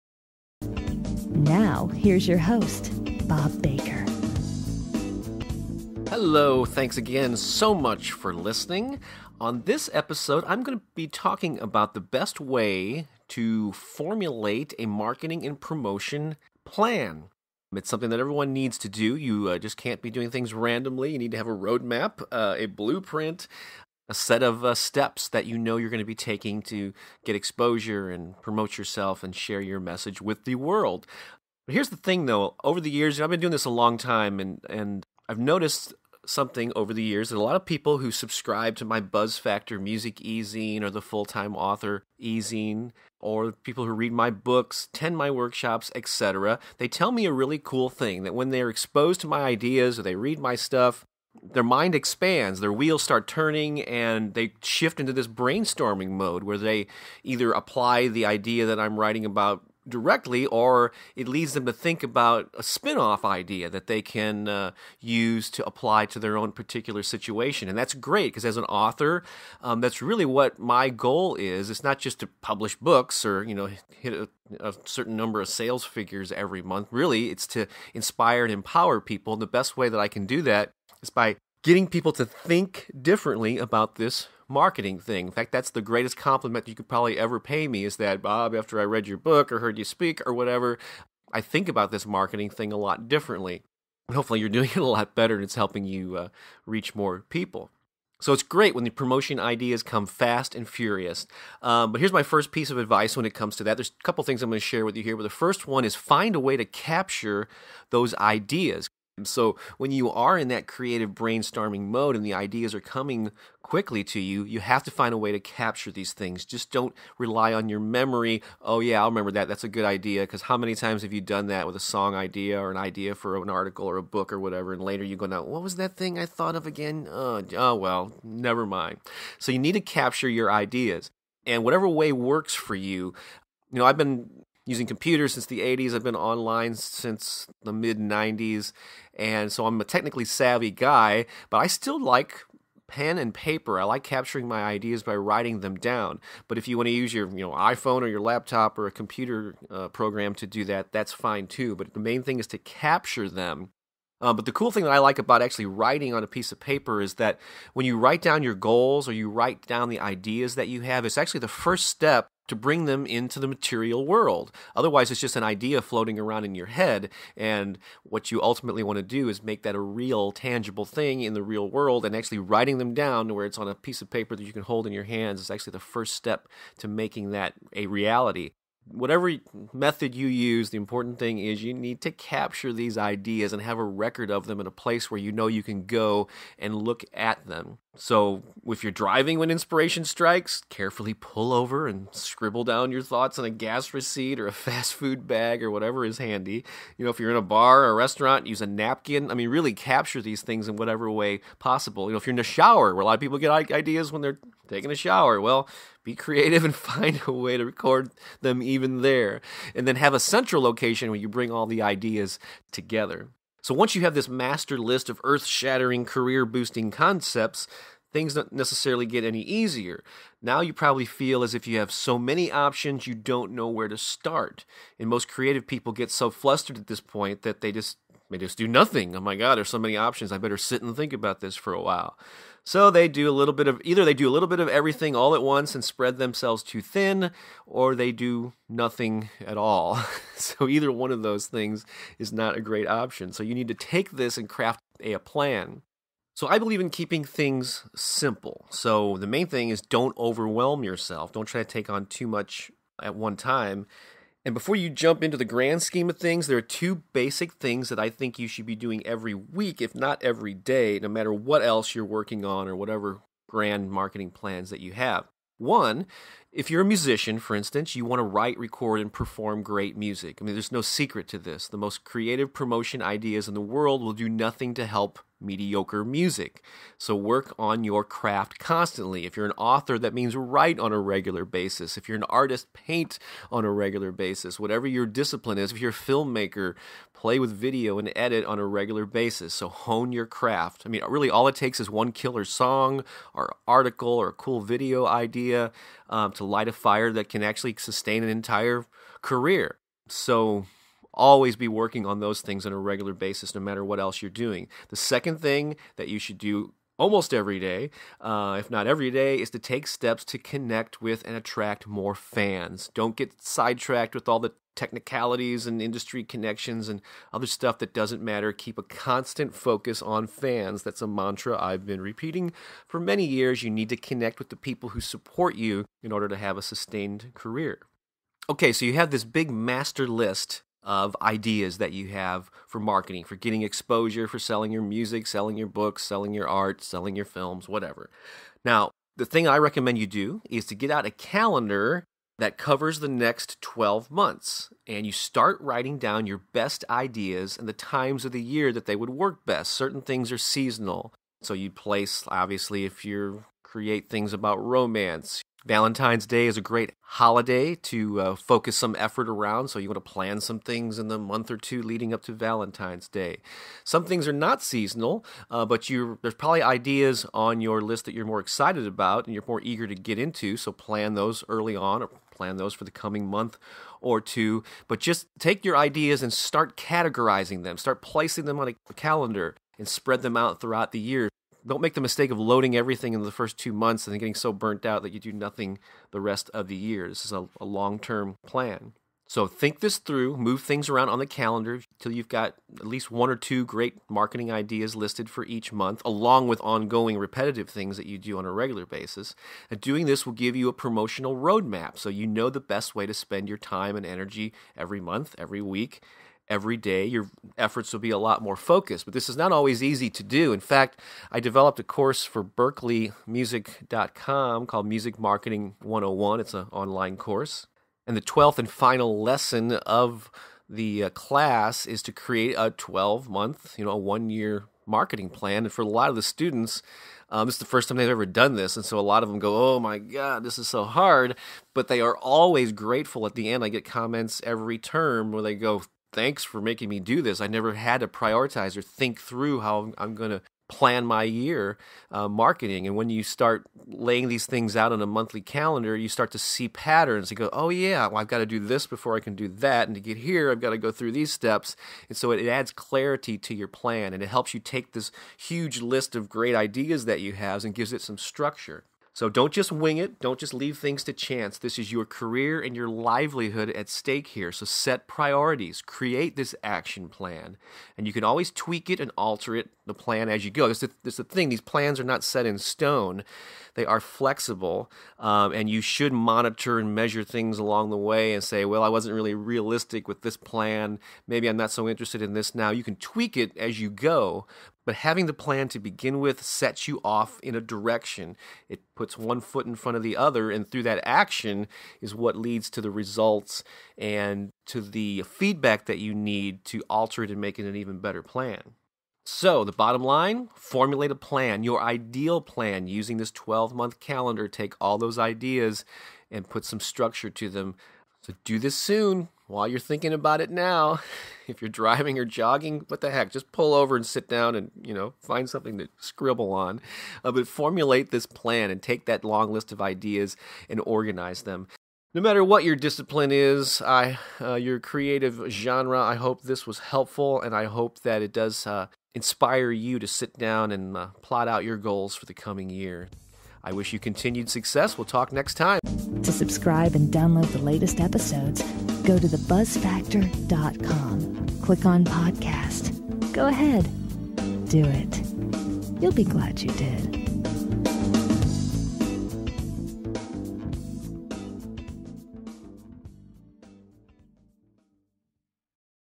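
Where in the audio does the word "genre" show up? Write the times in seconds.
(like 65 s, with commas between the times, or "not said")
525 s.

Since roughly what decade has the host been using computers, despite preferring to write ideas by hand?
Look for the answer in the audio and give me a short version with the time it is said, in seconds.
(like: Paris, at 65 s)
the 80s, at 135 s.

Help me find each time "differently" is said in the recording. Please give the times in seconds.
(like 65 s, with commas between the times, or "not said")
82 s, 93 s.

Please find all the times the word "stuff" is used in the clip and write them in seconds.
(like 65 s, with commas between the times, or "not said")
50 s, 317 s.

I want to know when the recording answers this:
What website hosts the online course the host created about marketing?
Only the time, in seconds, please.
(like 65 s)
412 s.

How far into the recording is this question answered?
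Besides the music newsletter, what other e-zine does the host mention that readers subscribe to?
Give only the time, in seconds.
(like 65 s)
41 s.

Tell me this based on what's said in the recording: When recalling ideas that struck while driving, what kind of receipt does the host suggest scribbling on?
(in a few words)
gas receipt.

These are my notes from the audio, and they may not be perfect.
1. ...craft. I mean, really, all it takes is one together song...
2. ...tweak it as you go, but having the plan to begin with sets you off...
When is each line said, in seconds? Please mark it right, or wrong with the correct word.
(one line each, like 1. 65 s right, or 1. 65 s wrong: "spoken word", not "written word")
1. 290 s wrong: "killer", not "together"
2. 482 s right.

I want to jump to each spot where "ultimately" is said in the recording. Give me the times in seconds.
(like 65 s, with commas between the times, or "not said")
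168 s.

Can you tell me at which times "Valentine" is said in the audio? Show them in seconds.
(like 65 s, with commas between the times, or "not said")
355 s, 362 s.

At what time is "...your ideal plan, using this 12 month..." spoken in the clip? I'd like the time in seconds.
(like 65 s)
501 s.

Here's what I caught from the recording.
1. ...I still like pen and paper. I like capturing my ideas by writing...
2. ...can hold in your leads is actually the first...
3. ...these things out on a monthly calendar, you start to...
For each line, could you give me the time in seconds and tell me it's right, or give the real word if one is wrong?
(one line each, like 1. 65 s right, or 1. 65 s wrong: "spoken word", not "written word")
1. 141 s right
2. 174 s wrong: "hands", not "leads"
3. 444 s right.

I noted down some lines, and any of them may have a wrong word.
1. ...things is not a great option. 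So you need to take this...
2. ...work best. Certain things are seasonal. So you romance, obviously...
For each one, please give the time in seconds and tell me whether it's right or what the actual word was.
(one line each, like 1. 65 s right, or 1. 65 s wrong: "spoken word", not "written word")
1. 241 s right
2. 349 s wrong: "place", not "romance".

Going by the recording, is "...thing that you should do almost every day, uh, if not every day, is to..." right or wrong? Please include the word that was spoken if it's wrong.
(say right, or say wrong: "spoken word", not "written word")
right.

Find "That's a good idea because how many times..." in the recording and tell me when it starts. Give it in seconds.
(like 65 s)
119 s.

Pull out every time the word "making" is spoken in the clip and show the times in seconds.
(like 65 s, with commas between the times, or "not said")
176 s, 436 s.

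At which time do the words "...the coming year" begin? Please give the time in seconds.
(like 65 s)
532 s.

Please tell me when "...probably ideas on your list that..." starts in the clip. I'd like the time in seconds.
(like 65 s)
366 s.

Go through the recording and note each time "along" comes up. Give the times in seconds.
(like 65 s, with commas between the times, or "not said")
396 s, 477 s.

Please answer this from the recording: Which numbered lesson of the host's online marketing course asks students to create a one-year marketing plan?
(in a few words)
12th.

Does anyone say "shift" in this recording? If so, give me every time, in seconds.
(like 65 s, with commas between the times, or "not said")
54 s.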